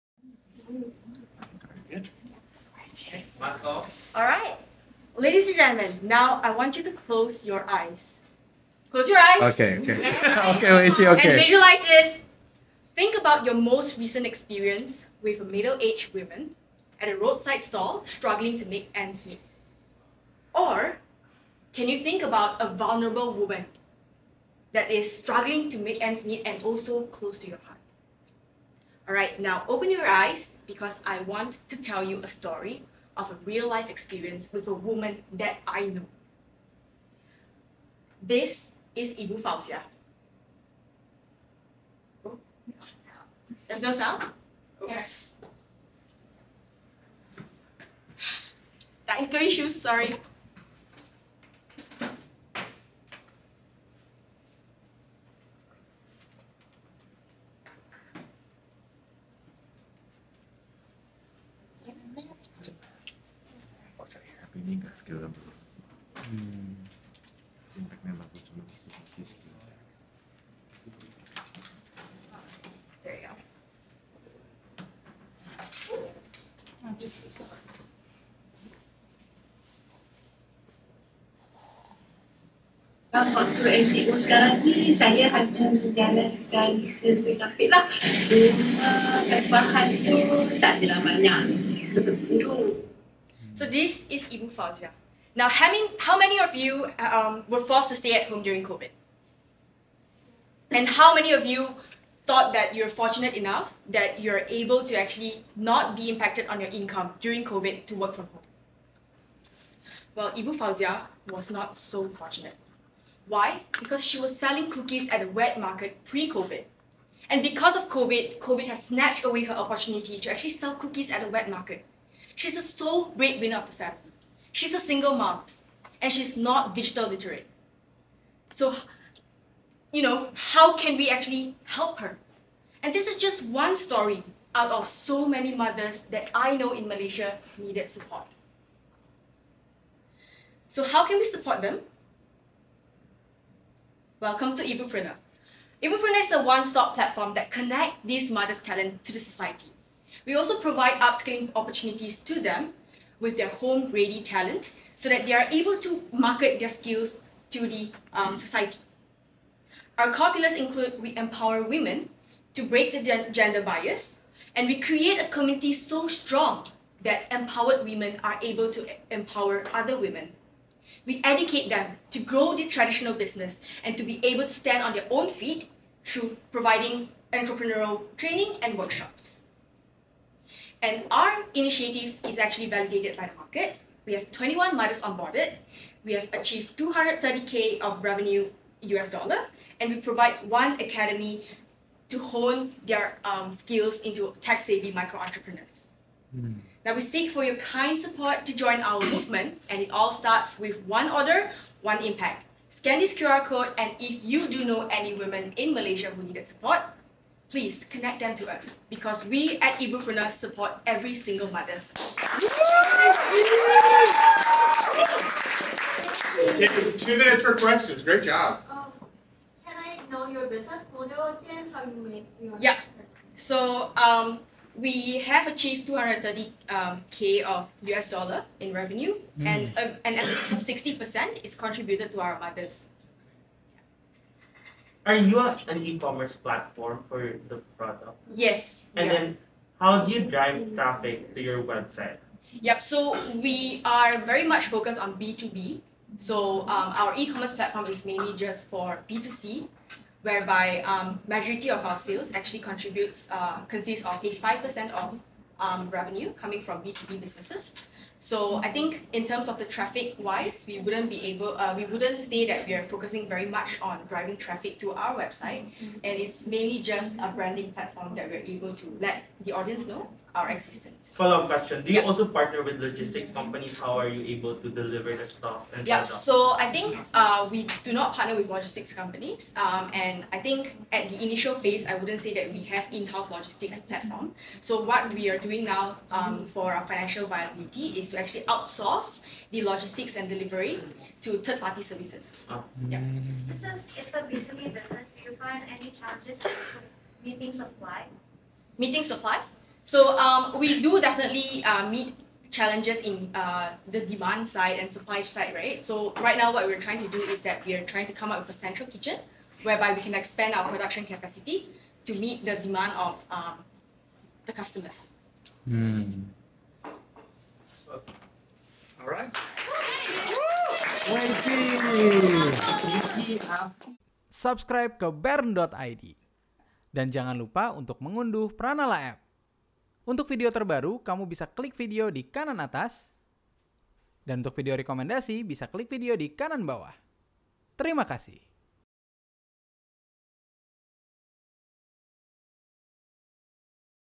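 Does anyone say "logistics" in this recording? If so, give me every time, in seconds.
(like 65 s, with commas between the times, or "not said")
272 s, 278 s, 283 s, 289 s.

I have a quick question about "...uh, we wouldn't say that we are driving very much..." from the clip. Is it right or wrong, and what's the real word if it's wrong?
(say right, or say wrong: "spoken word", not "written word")
wrong: "focusing", not "driving".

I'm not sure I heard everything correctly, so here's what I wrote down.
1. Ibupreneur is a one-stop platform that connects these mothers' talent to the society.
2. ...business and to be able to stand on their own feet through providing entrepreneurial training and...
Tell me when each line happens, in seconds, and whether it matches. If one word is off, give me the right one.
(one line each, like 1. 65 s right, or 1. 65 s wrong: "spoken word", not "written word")
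1. 145 s right
2. 173 s right.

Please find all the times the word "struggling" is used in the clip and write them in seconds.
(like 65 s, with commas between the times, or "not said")
18 s, 25 s.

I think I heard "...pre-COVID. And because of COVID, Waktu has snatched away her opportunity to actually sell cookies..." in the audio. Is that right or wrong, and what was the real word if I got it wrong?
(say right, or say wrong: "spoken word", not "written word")
wrong: "COVID", not "Waktu".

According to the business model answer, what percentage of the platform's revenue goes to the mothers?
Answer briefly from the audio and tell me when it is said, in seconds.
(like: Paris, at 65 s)
60%, at 230 s.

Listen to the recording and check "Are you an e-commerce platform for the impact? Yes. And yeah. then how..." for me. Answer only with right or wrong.
wrong.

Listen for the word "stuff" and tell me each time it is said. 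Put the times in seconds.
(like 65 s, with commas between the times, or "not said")
275 s.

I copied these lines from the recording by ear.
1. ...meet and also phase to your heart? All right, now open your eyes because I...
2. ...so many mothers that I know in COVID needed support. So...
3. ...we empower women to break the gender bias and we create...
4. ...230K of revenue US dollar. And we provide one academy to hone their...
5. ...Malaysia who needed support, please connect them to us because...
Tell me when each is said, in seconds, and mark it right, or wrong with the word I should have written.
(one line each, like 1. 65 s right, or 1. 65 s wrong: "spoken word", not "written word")
1. 26 s wrong: "close", not "phase"
2. 134 s wrong: "Malaysia", not "COVID"
3. 161 s right
4. 186 s right
5. 205 s right.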